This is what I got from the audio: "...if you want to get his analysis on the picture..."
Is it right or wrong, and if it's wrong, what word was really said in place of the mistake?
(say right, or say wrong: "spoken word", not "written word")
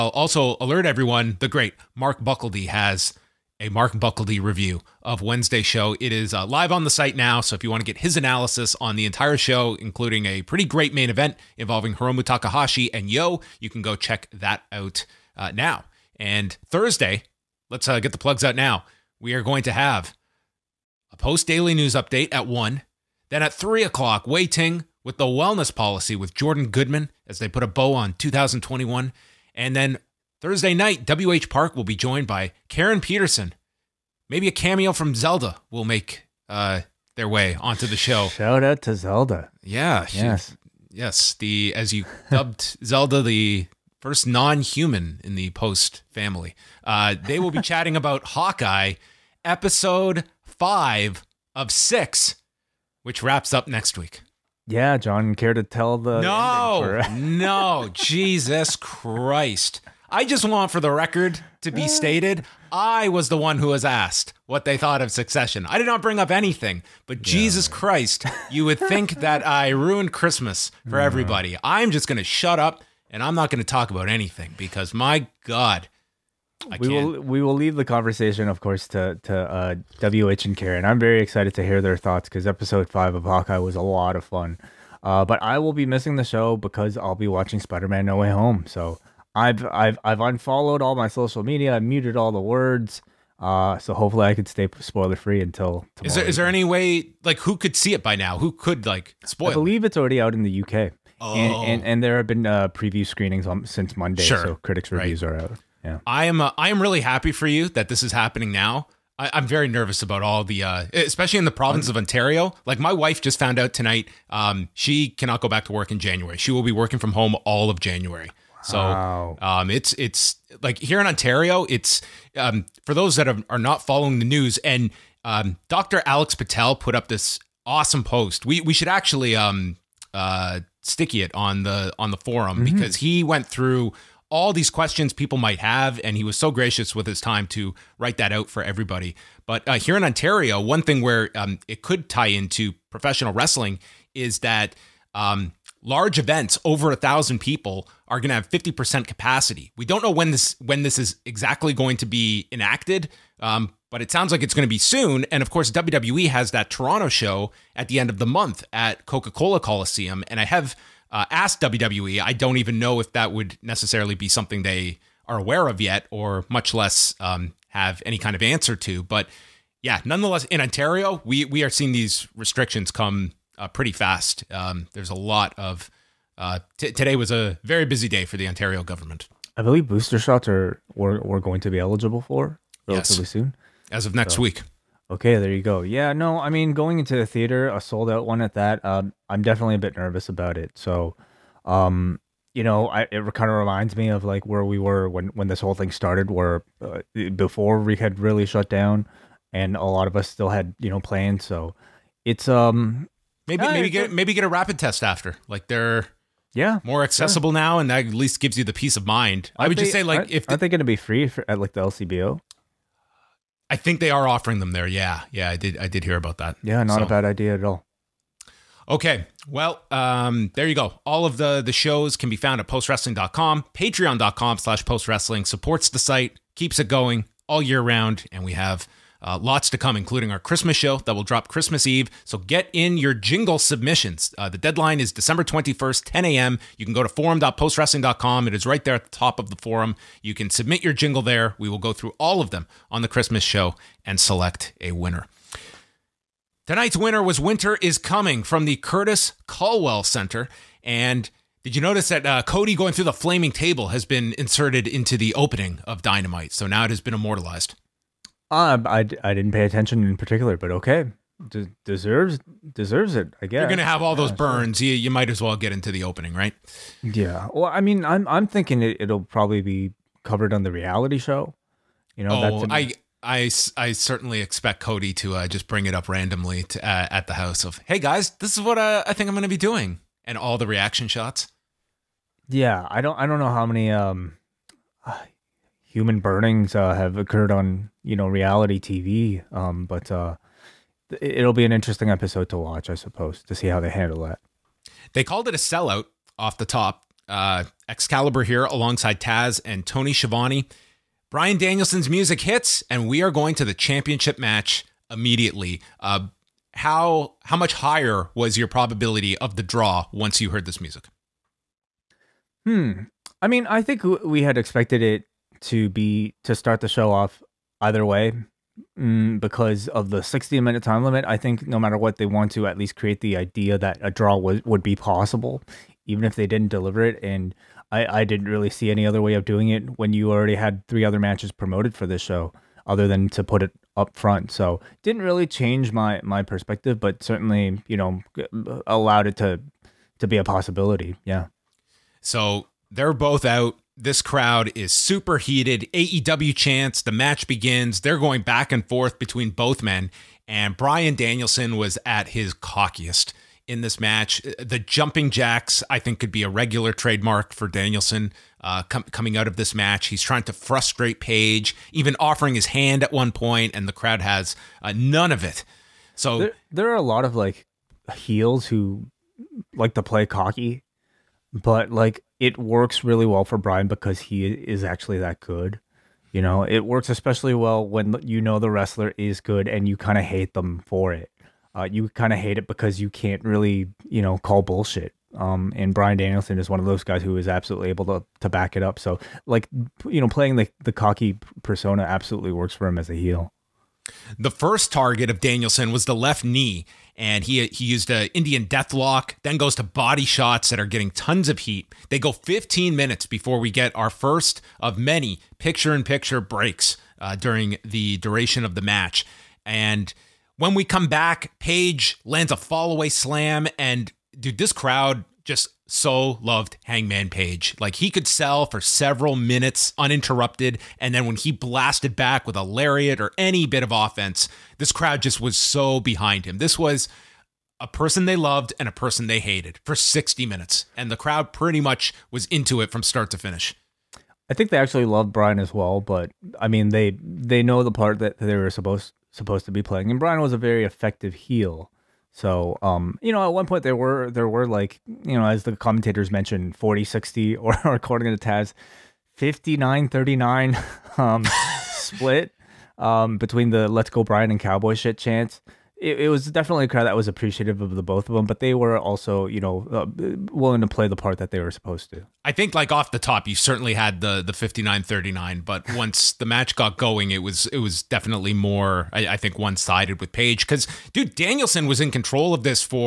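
wrong: "entire", not "picture".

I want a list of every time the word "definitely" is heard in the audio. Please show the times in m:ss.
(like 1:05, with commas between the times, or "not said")
3:09, 7:36, 7:48.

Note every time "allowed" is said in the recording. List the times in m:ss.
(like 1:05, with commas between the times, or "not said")
5:38.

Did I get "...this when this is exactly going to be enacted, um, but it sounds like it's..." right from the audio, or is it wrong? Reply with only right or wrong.
right.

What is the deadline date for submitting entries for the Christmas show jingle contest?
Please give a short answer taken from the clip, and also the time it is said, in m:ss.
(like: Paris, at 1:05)
December 21st, at 3:55.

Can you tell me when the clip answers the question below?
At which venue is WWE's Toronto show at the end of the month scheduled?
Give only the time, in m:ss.
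2:39.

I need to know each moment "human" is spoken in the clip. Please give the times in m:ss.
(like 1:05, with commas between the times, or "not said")
0:44, 4:45.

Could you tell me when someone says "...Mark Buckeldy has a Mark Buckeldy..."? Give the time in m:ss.
0:01.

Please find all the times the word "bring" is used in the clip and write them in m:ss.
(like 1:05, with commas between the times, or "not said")
1:06, 4:35.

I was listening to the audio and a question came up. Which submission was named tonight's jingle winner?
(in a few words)
Winter is Coming.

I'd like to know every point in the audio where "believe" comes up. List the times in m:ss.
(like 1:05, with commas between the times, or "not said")
1:39, 2:59.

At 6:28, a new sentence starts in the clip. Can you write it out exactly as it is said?
So, like, you know, playing the, the cocky persona absolutely works for him as a heel.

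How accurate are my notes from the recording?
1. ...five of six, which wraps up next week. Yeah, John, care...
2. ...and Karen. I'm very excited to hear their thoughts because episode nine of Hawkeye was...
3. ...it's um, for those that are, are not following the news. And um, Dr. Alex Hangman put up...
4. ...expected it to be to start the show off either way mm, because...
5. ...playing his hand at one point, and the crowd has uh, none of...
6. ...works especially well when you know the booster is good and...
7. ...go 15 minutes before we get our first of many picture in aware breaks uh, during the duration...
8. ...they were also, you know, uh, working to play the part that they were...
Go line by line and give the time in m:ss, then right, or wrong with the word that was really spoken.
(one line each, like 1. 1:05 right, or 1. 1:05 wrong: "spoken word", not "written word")
1. 0:50 right
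2. 1:20 wrong: "five", not "nine"
3. 2:01 wrong: "Patel", not "Hangman"
4. 5:14 right
5. 6:02 wrong: "offering", not "playing"
6. 6:16 wrong: "wrestler", not "booster"
7. 6:42 wrong: "picture", not "aware"
8. 7:38 wrong: "willing", not "working".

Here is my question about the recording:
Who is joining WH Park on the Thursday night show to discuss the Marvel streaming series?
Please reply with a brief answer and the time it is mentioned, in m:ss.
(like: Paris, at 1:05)
Karen Peterson, at 0:32.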